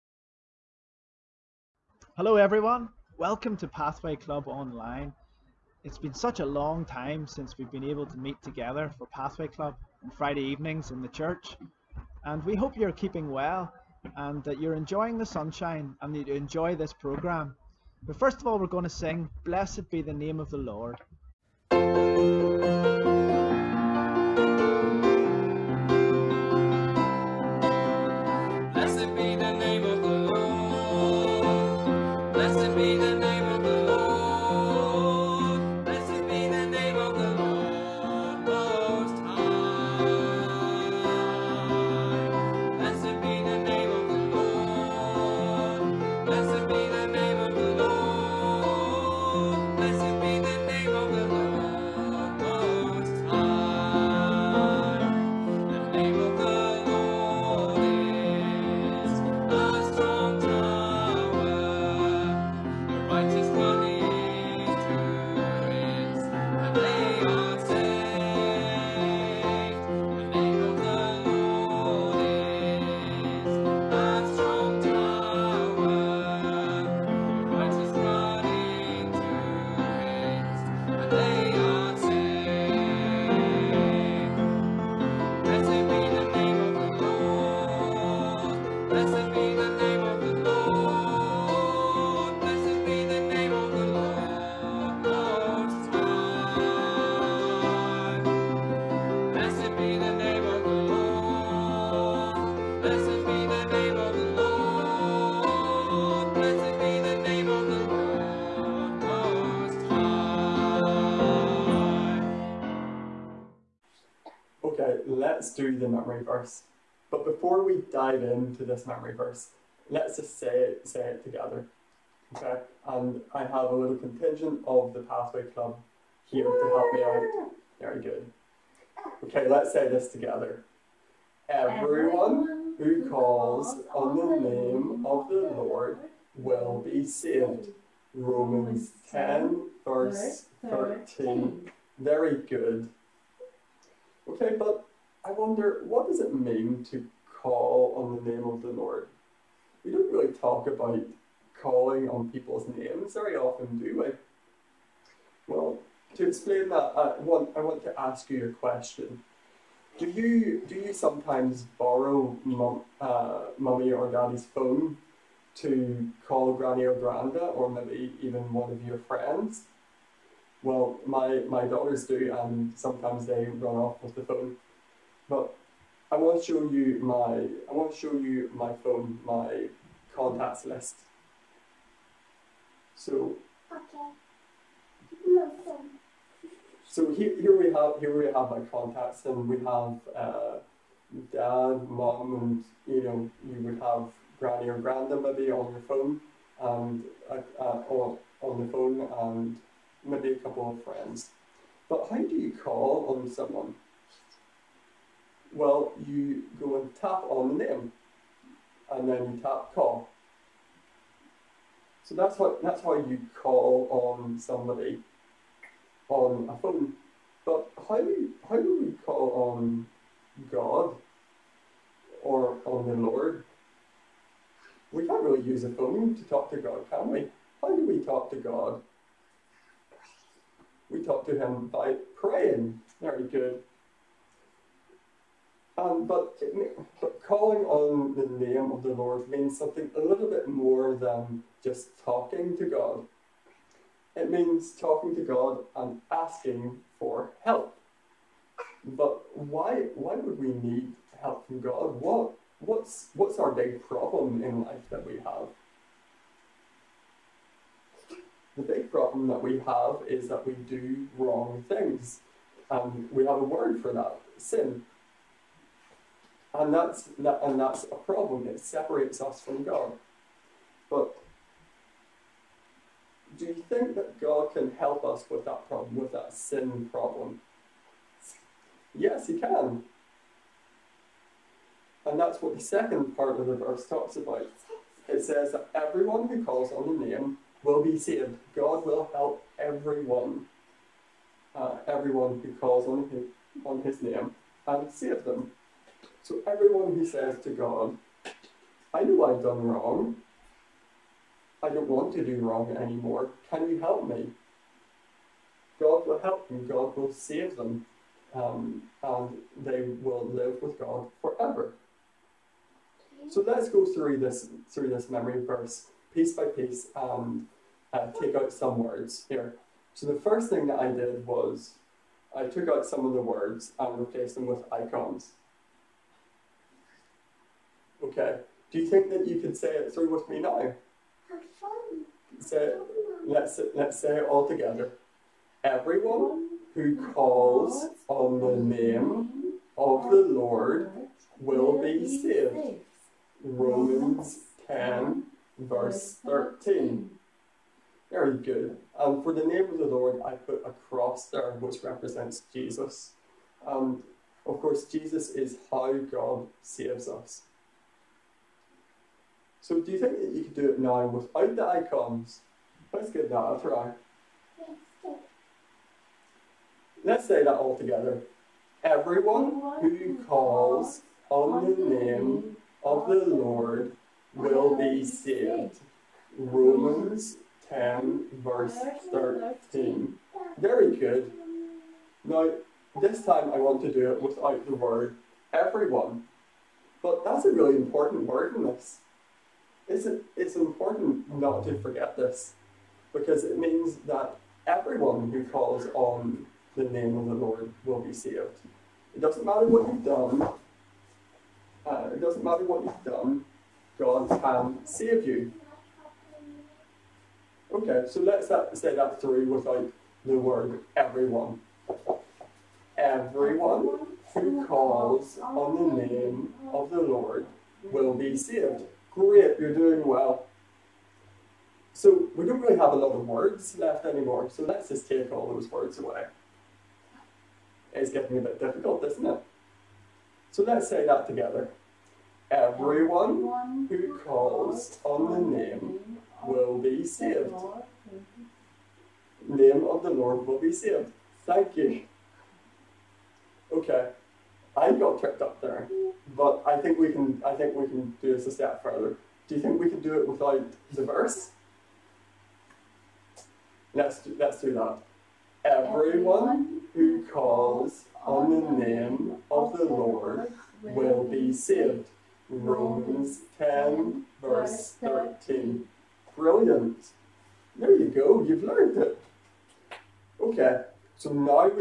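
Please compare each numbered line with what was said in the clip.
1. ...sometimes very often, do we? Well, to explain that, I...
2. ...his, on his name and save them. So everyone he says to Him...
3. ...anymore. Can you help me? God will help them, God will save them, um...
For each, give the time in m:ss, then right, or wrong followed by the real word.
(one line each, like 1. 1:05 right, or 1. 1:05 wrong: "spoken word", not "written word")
1. 2:32 wrong: "names", not "sometimes"
2. 4:53 wrong: "God", not "Him"
3. 5:02 right.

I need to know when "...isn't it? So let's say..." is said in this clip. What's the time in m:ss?
7:09.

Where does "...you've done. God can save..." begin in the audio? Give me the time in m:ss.
6:42.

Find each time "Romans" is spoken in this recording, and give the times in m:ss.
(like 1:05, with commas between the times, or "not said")
2:18, 5:43, 6:16, 7:42.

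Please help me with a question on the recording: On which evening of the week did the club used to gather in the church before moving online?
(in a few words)
Friday.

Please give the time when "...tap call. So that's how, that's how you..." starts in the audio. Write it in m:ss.
3:29.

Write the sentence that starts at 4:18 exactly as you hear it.
The big problem that we have is that we do wrong things.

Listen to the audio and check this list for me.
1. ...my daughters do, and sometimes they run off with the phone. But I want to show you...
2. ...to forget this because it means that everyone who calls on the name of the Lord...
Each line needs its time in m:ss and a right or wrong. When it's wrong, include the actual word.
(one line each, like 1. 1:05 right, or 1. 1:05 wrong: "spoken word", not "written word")
1. 2:51 right
2. 6:31 right.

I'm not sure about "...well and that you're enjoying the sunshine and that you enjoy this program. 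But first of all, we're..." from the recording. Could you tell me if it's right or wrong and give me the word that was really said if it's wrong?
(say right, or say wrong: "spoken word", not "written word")
right.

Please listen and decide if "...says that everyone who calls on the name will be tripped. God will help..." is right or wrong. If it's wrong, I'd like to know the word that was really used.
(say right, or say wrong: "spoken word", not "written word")
wrong: "saved", not "tripped".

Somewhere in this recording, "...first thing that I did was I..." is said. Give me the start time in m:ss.
5:20.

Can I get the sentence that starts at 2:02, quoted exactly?
Okay, and I have a little contingent of the Pathway Club here to help me out.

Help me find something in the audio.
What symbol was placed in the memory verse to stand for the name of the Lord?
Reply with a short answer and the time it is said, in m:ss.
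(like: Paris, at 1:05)
a cross, at 5:50.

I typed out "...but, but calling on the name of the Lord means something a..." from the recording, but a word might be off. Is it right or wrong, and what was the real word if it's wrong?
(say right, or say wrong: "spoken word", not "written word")
right.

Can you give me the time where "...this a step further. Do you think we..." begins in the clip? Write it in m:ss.
7:28.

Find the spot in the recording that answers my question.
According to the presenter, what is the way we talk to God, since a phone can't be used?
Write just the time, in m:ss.
3:52.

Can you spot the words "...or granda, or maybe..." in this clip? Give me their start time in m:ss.
2:46.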